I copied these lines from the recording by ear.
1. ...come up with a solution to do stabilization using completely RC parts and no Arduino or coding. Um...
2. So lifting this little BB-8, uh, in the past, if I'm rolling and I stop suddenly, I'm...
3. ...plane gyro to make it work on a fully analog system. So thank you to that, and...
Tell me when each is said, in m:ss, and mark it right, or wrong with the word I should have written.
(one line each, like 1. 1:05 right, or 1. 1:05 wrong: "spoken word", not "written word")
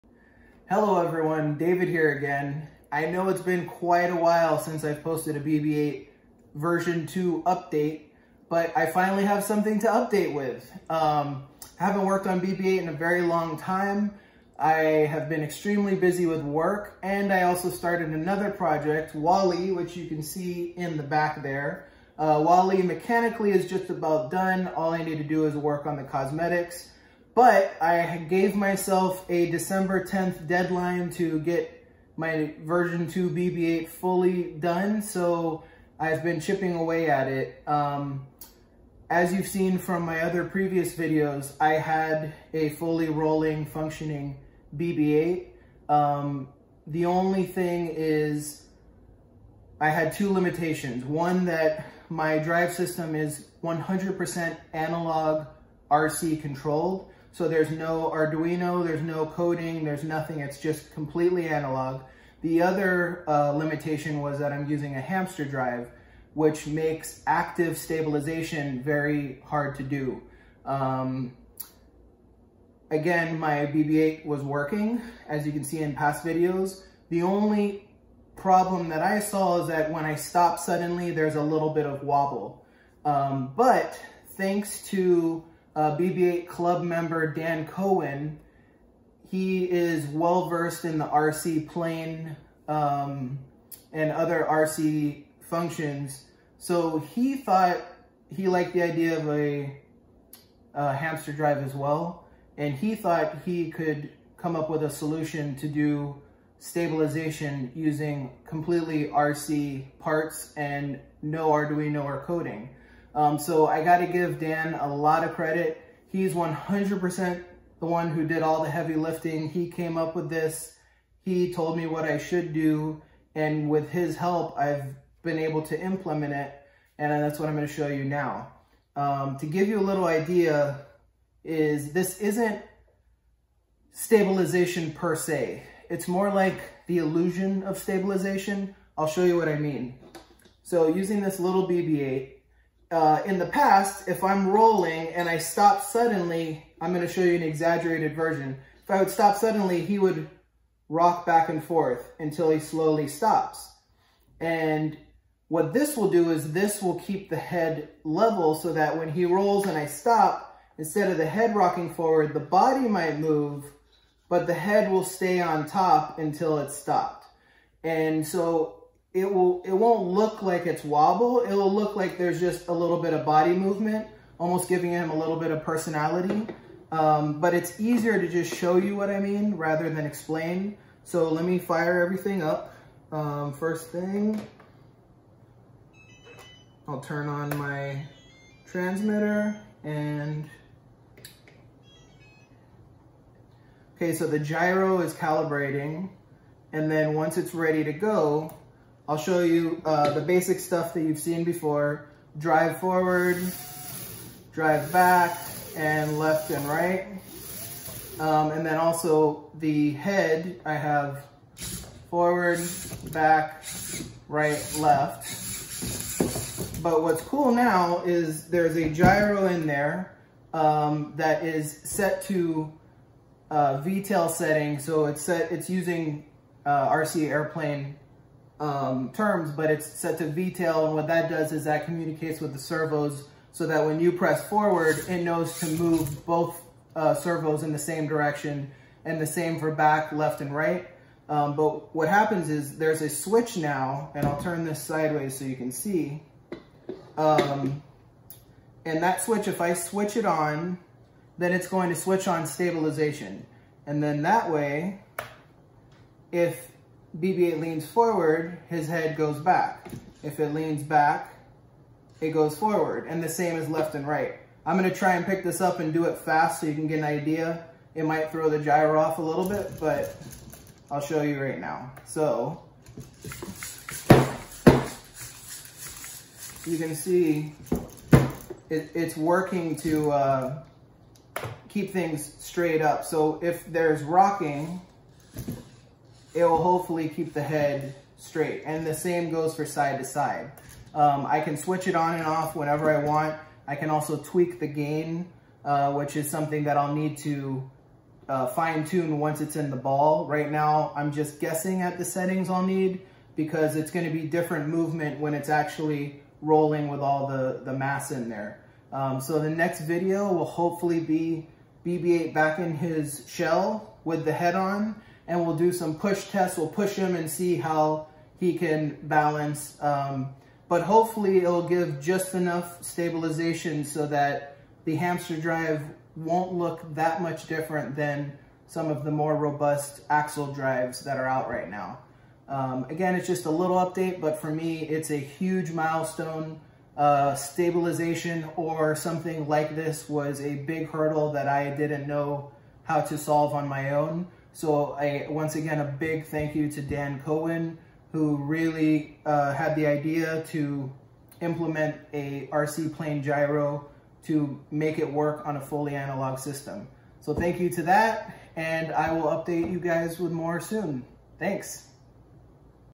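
1. 1:44 right
2. 2:20 wrong: "using", not "lifting"
3. 5:52 right.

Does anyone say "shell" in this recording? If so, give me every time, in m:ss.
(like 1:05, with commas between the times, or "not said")
5:13.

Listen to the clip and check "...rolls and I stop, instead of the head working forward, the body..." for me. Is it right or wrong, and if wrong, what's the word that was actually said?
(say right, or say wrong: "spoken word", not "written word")
wrong: "rocking", not "working".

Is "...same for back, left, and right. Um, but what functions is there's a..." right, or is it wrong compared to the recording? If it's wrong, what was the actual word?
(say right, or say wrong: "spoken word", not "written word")
wrong: "happens", not "functions".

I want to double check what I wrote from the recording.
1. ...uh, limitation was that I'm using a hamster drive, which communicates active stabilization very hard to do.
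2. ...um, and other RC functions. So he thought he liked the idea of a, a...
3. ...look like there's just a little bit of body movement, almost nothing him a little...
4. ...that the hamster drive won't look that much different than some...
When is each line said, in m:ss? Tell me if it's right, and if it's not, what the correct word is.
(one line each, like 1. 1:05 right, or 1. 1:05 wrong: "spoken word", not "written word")
1. 1:03 wrong: "makes", not "communicates"
2. 1:32 right
3. 2:51 wrong: "giving", not "nothing"
4. 5:24 right.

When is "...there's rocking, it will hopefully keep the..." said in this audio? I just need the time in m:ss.
4:43.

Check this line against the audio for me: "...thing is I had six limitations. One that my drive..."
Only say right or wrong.
wrong.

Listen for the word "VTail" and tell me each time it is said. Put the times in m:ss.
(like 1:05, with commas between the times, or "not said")
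3:43, 3:50.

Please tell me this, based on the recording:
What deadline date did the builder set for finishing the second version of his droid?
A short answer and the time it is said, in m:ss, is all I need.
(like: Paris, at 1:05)
December 10th, at 0:29.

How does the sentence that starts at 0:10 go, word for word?
Um, haven't worked on BB-8 in a very long time.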